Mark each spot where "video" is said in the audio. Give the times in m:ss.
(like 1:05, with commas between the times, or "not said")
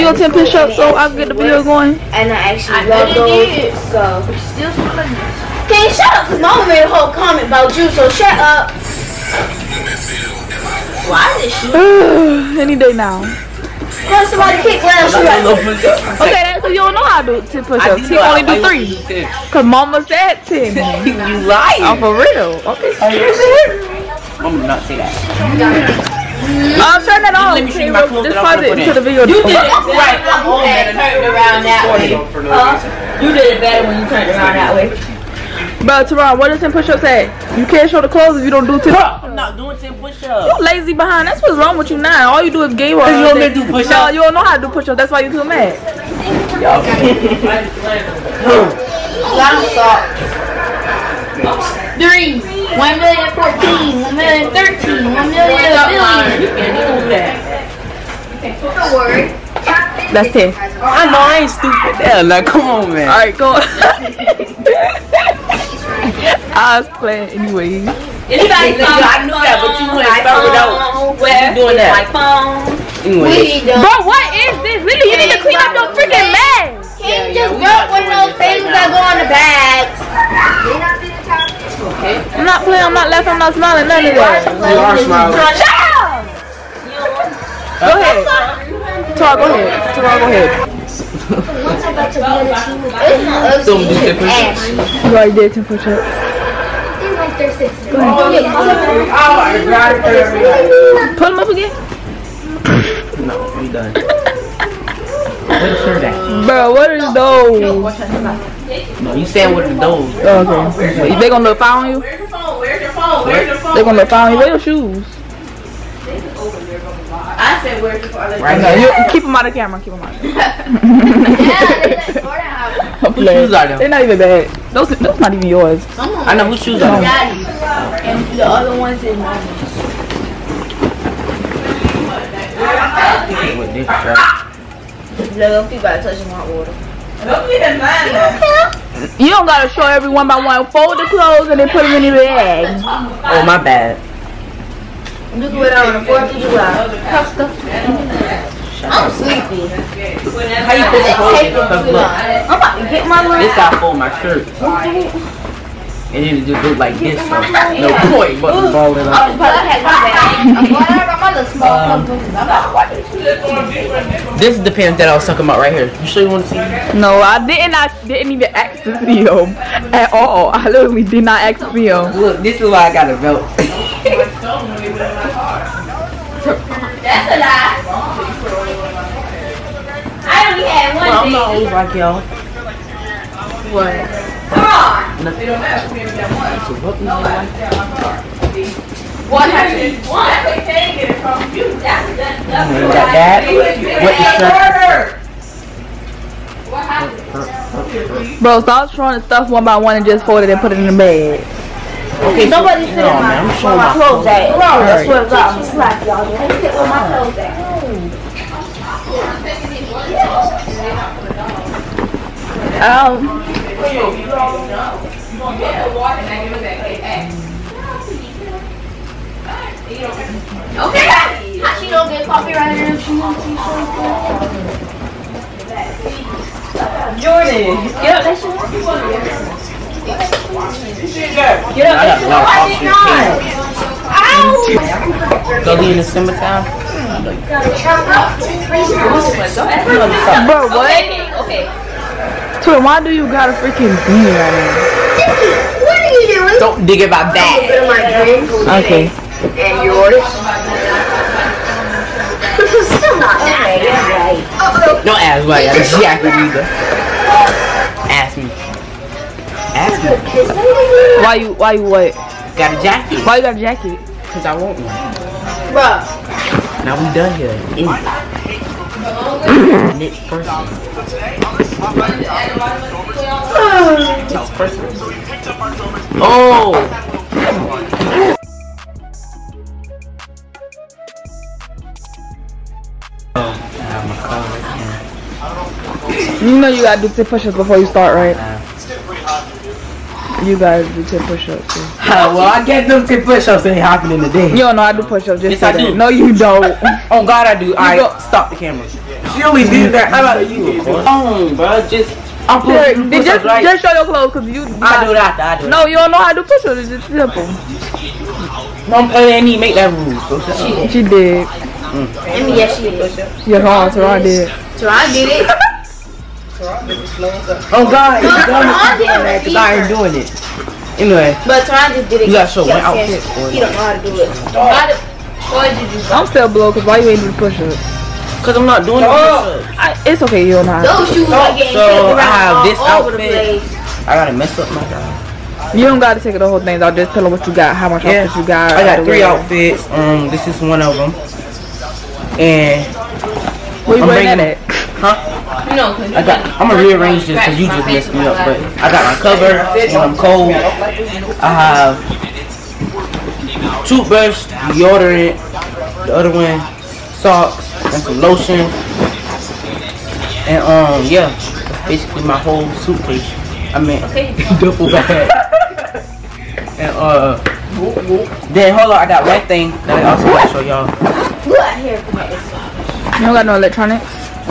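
0:01, 0:28.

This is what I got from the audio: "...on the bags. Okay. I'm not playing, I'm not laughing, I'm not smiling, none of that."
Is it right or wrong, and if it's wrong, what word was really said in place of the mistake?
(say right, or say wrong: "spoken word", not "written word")
right.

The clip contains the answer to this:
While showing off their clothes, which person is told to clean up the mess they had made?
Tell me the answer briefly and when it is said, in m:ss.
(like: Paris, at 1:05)
Lily, at 1:14.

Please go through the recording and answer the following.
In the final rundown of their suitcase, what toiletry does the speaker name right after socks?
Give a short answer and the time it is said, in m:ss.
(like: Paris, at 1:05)
Lotion, at 5:58.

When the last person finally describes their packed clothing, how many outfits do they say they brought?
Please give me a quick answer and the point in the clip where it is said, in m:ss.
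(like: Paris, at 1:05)
3, at 5:39.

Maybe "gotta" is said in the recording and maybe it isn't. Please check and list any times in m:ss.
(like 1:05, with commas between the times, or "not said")
2:19, 4:46, 5:35, 6:10.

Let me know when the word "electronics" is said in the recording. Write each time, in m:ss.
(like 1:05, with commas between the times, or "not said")
6:13.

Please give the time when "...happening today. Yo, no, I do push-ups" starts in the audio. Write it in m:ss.
4:53.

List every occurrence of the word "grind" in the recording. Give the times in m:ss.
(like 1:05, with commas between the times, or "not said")
not said.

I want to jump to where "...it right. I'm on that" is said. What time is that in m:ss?
0:29.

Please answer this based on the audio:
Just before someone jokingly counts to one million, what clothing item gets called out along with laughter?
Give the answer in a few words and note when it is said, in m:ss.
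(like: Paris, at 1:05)
Long socks, at 0:49.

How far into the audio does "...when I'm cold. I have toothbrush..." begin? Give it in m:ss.
5:49.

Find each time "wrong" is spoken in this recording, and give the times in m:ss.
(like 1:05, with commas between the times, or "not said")
0:41, 1:30.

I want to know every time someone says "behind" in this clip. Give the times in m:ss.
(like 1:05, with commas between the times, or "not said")
0:40.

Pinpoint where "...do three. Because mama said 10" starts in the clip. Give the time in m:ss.
0:18.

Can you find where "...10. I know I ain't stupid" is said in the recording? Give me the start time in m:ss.
1:00.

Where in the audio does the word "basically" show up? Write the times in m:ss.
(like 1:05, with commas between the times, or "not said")
6:01.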